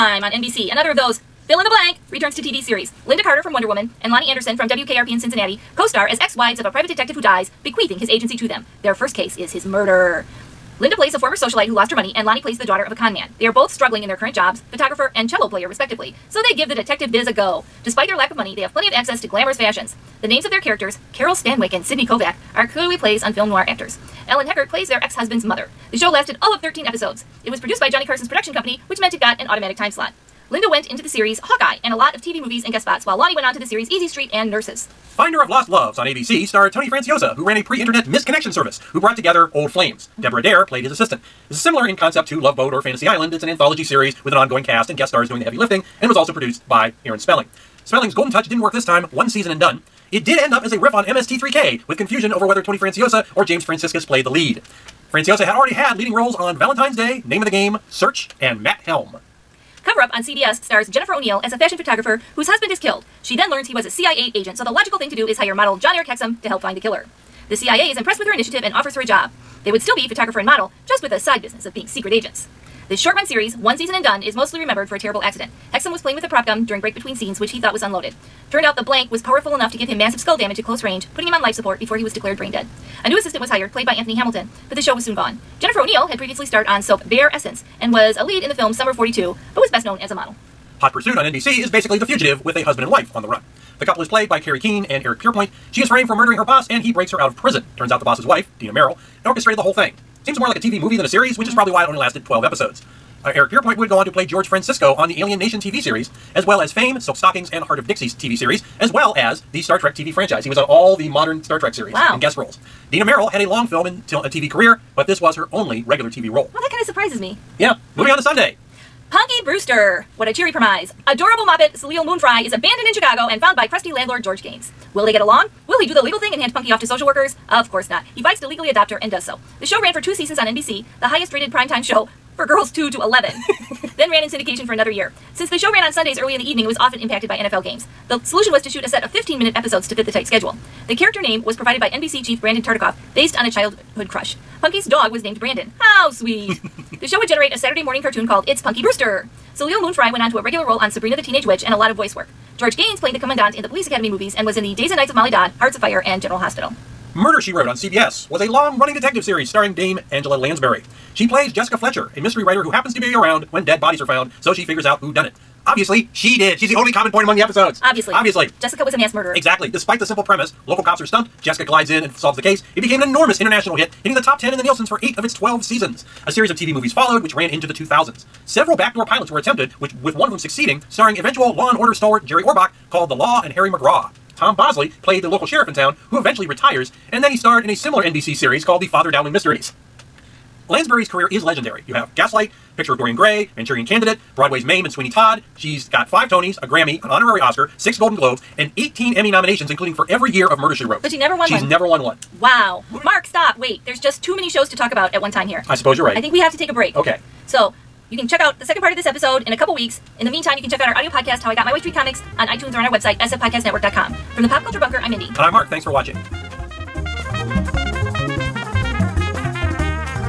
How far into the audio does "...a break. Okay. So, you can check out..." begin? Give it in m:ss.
3:26.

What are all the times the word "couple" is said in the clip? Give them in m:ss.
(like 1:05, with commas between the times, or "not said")
1:33, 3:29.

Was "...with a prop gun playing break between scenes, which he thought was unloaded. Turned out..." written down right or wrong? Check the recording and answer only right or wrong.
wrong.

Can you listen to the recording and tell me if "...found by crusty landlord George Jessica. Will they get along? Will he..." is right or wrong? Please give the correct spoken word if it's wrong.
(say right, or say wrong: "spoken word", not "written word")
wrong: "Gaynes", not "Jessica".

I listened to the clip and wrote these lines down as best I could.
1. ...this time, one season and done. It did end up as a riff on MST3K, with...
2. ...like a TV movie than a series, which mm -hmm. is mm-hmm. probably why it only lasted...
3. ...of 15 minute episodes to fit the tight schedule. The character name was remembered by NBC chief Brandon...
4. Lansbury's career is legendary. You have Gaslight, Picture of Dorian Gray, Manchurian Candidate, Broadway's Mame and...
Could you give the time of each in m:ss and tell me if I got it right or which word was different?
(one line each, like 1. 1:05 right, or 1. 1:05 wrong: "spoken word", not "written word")
1. 0:48 right
2. 1:40 right
3. 2:19 wrong: "provided", not "remembered"
4. 3:10 right.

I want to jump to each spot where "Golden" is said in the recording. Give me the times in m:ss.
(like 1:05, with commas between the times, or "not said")
0:48, 3:17.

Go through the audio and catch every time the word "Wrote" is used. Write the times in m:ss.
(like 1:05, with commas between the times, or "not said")
2:37, 3:20.